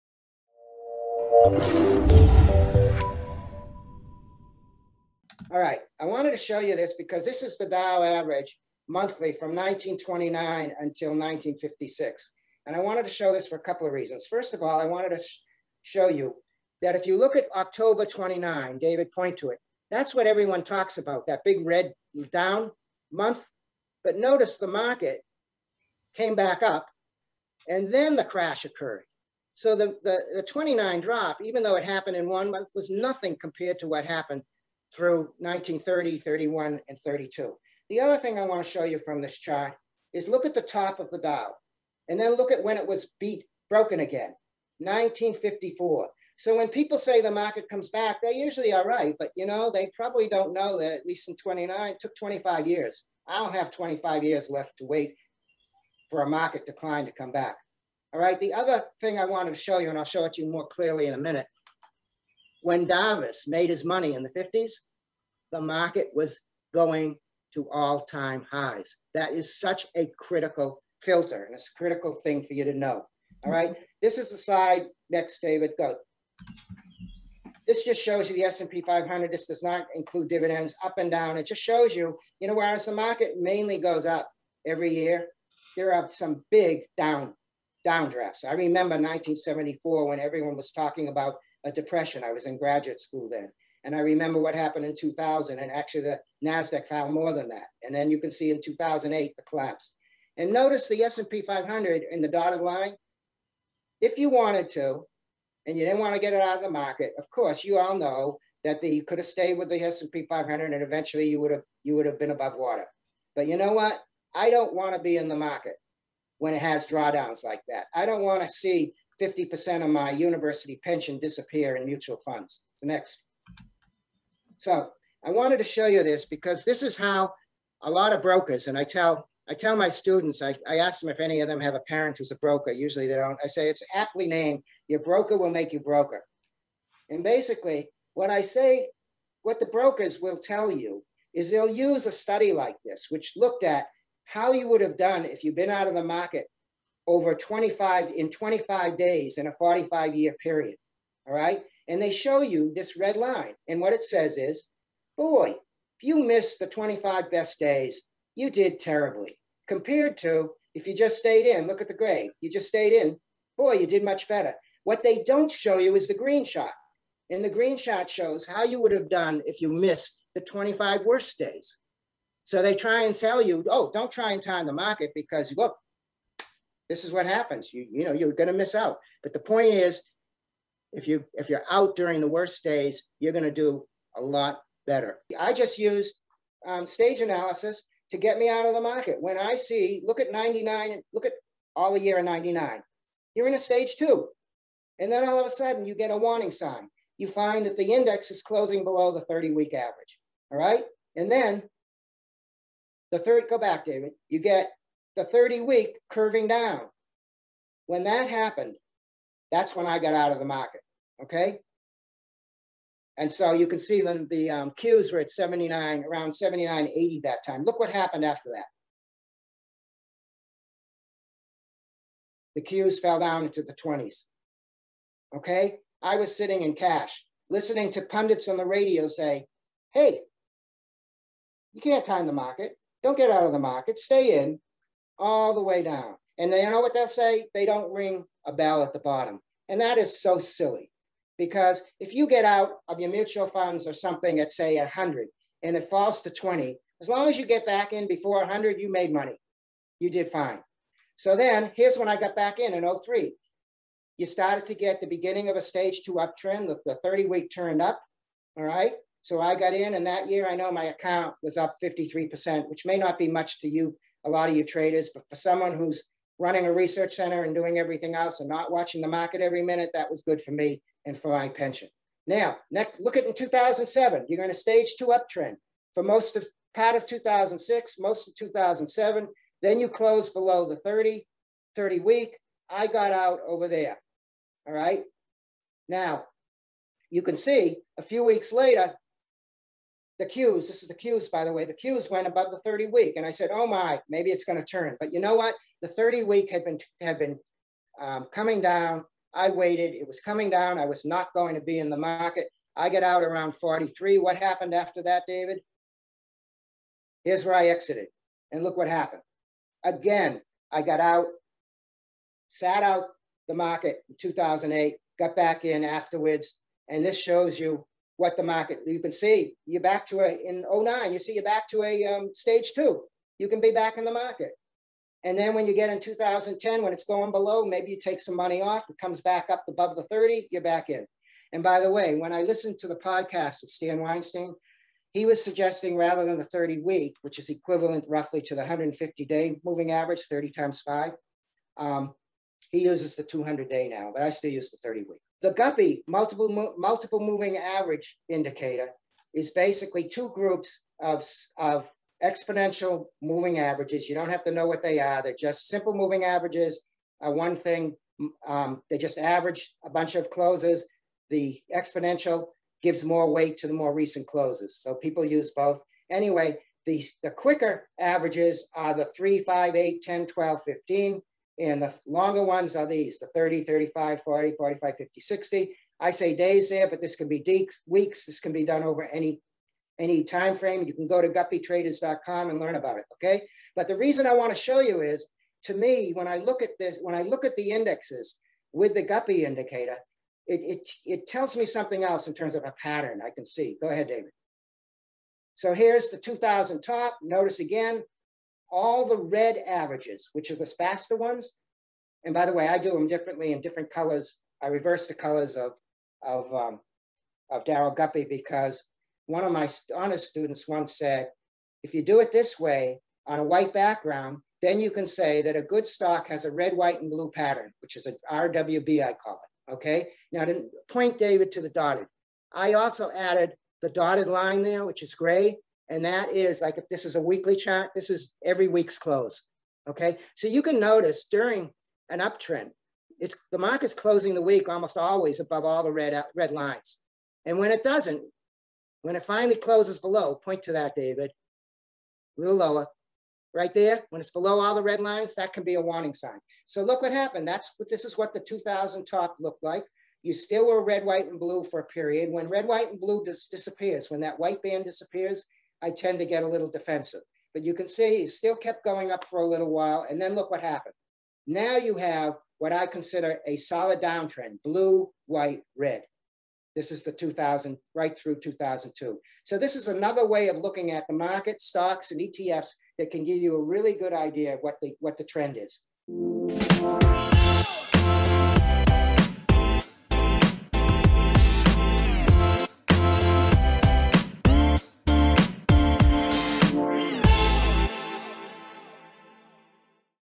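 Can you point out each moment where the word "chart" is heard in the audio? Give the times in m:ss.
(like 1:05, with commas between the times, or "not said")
0:39, 7:07.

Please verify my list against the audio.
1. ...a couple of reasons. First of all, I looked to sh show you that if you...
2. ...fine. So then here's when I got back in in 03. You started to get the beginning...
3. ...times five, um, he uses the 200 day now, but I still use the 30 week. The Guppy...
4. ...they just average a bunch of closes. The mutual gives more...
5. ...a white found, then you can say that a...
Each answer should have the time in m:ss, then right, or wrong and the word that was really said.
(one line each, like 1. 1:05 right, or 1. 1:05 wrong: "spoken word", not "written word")
1. 0:13 wrong: "wanted", not "looked"
2. 4:10 right
3. 5:40 right
4. 5:58 wrong: "exponential", not "mutual"
5. 6:53 wrong: "background", not "found".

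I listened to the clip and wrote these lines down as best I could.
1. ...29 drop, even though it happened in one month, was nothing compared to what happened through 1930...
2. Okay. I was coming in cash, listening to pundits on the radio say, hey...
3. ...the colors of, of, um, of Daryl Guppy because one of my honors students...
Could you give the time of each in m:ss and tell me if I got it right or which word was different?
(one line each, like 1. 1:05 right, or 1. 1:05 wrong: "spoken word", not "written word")
1. 0:30 right
2. 3:45 wrong: "sitting", not "coming"
3. 6:45 right.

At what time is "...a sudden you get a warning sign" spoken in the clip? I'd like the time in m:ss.
3:15.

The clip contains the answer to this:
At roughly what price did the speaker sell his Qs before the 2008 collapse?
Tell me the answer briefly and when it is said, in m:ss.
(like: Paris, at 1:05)
43, at 5:03.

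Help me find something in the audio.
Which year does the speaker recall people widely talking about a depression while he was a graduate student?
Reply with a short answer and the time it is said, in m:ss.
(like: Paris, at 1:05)
1974, at 1:28.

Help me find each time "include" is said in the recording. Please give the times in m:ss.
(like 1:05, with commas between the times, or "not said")
1:19.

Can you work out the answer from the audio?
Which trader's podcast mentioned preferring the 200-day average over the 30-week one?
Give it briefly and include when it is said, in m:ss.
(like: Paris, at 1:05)
Stan Weinstein, at 5:33.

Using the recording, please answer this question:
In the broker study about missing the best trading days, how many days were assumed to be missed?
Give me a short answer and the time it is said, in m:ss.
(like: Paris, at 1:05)
25, at 2:28.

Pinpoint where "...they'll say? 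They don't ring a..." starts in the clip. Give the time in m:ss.
3:56.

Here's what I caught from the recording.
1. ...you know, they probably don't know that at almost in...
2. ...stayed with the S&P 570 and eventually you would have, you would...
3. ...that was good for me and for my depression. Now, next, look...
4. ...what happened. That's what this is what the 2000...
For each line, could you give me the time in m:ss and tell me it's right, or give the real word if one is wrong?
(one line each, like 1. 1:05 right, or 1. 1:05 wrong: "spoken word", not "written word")
1. 0:49 wrong: "least", not "almost"
2. 1:49 wrong: "500", not "570"
3. 4:29 wrong: "pension", not "depression"
4. 7:27 right.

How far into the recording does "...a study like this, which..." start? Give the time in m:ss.
2:22.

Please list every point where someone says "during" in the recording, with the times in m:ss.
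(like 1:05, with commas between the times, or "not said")
3:01, 7:11.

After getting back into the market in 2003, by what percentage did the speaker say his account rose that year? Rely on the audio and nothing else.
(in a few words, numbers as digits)
53%.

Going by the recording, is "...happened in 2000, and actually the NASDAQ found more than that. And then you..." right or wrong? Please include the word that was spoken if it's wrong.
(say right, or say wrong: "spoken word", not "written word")
right.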